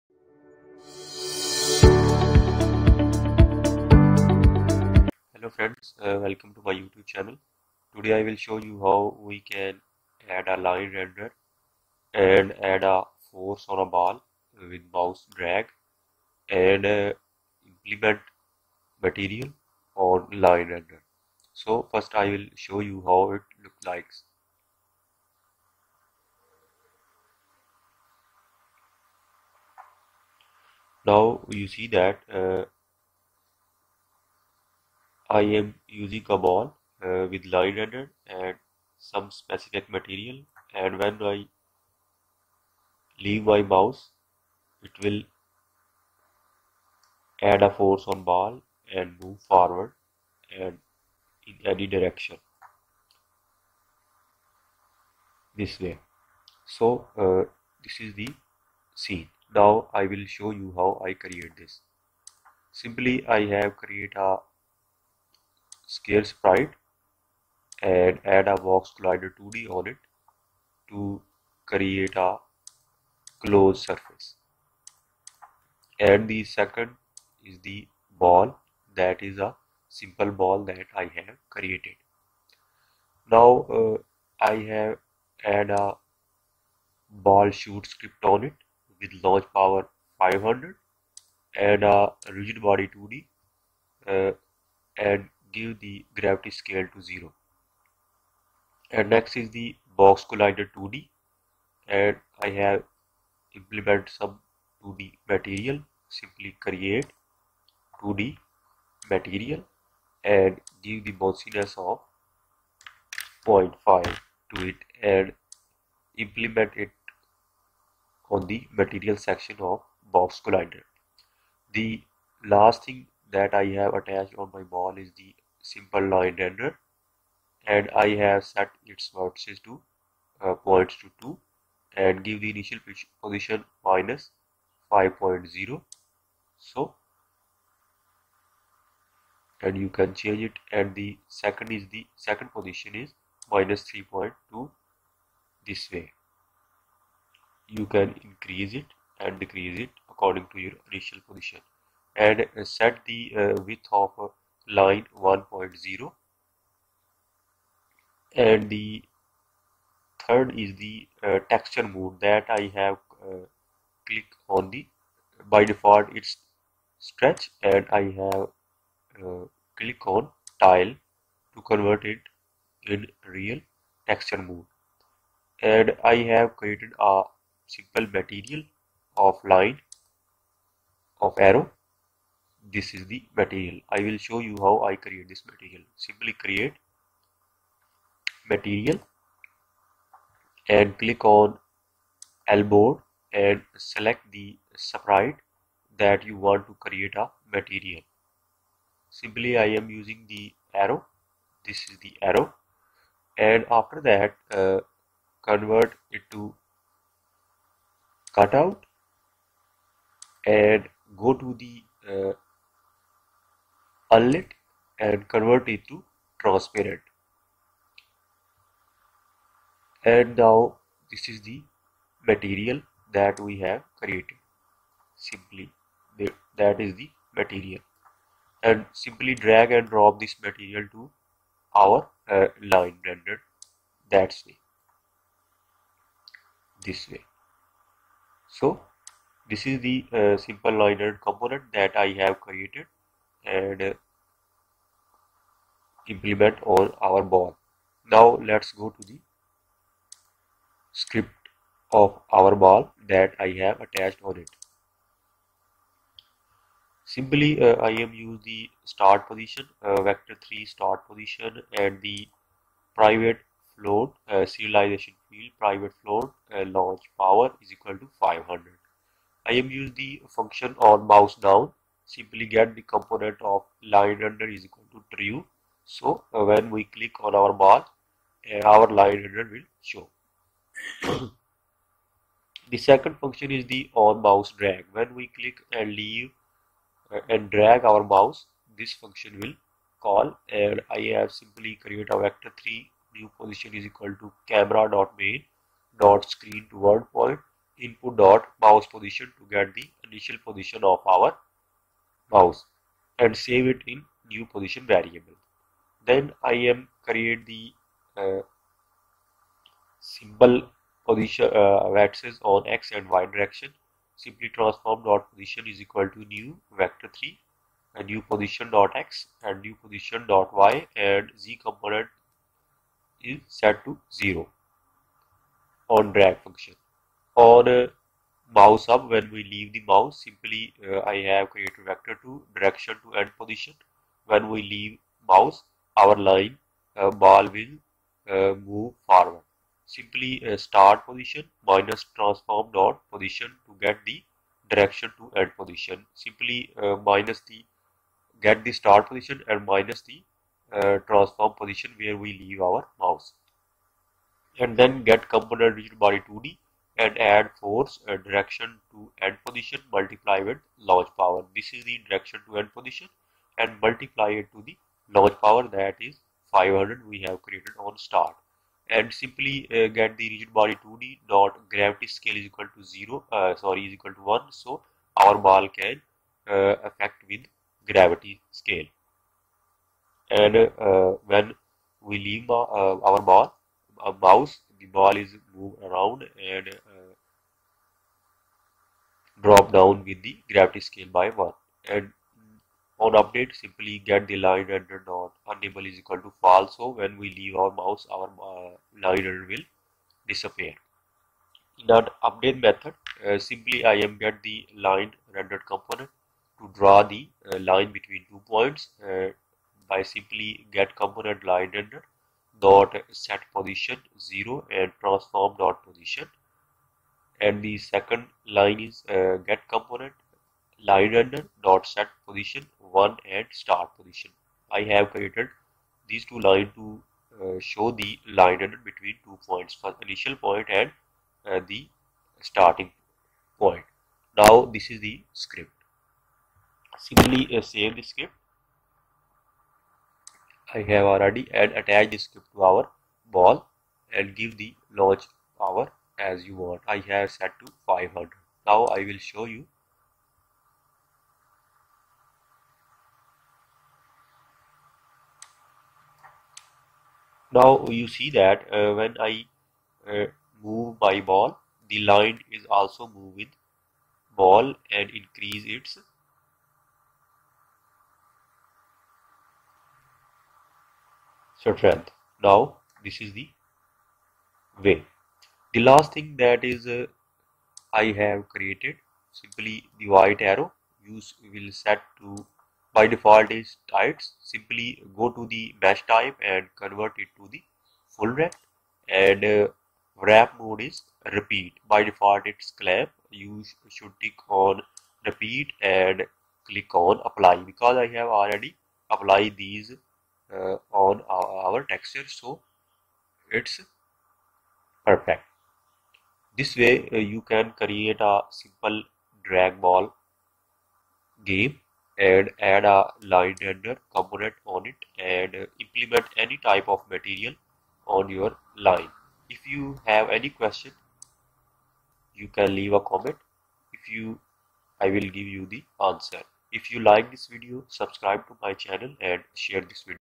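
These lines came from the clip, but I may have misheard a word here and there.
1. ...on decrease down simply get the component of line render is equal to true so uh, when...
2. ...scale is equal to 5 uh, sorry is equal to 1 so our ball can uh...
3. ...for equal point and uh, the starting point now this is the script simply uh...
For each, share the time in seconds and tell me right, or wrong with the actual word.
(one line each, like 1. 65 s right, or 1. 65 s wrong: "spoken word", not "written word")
1. 270 s wrong: "mouse", not "decrease"
2. 372 s wrong: "0", not "5"
3. 429 s wrong: "initial", not "equal".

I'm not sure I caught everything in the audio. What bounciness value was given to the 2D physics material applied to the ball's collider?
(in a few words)
0.5.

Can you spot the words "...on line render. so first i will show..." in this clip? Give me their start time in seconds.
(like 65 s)
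19 s.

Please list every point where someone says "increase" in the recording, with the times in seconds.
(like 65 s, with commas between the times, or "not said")
148 s, 465 s.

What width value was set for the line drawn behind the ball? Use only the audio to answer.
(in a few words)
1.0.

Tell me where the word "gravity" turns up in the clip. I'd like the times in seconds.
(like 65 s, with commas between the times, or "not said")
96 s, 371 s, 377 s, 390 s.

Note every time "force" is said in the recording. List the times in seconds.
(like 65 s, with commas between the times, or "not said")
13 s, 47 s, 357 s.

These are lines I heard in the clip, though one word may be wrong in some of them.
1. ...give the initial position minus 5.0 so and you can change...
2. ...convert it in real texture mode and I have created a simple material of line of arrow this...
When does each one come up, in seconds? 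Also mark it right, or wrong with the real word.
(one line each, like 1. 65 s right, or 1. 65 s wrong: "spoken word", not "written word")
1. 132 s right
2. 171 s right.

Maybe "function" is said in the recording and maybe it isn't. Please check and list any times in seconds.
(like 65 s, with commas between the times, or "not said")
270 s, 283 s, 289 s, 326 s.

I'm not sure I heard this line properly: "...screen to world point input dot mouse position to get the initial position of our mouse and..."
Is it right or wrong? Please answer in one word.
right.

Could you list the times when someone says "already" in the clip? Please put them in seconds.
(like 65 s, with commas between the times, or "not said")
441 s, 498 s.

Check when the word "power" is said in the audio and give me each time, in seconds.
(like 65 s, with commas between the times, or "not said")
89 s, 267 s, 361 s, 365 s, 445 s.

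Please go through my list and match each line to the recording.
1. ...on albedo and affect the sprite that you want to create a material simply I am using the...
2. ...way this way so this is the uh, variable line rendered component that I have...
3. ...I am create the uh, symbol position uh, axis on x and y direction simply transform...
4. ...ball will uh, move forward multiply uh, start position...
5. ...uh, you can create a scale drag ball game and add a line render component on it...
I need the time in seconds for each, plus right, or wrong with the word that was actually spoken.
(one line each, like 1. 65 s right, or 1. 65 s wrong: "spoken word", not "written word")
1. 191 s wrong: "select", not "affect"
2. 234 s wrong: "simple", not "variable"
3. 306 s right
4. 337 s wrong: "simply", not "multiply"
5. 507 s wrong: "simple", not "scale".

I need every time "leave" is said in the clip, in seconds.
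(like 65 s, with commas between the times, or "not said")
43 s, 286 s, 329 s, 334 s, 352 s, 382 s, 397 s, 522 s.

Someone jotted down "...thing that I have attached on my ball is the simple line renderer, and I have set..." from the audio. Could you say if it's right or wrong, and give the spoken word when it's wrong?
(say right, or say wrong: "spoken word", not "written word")
right.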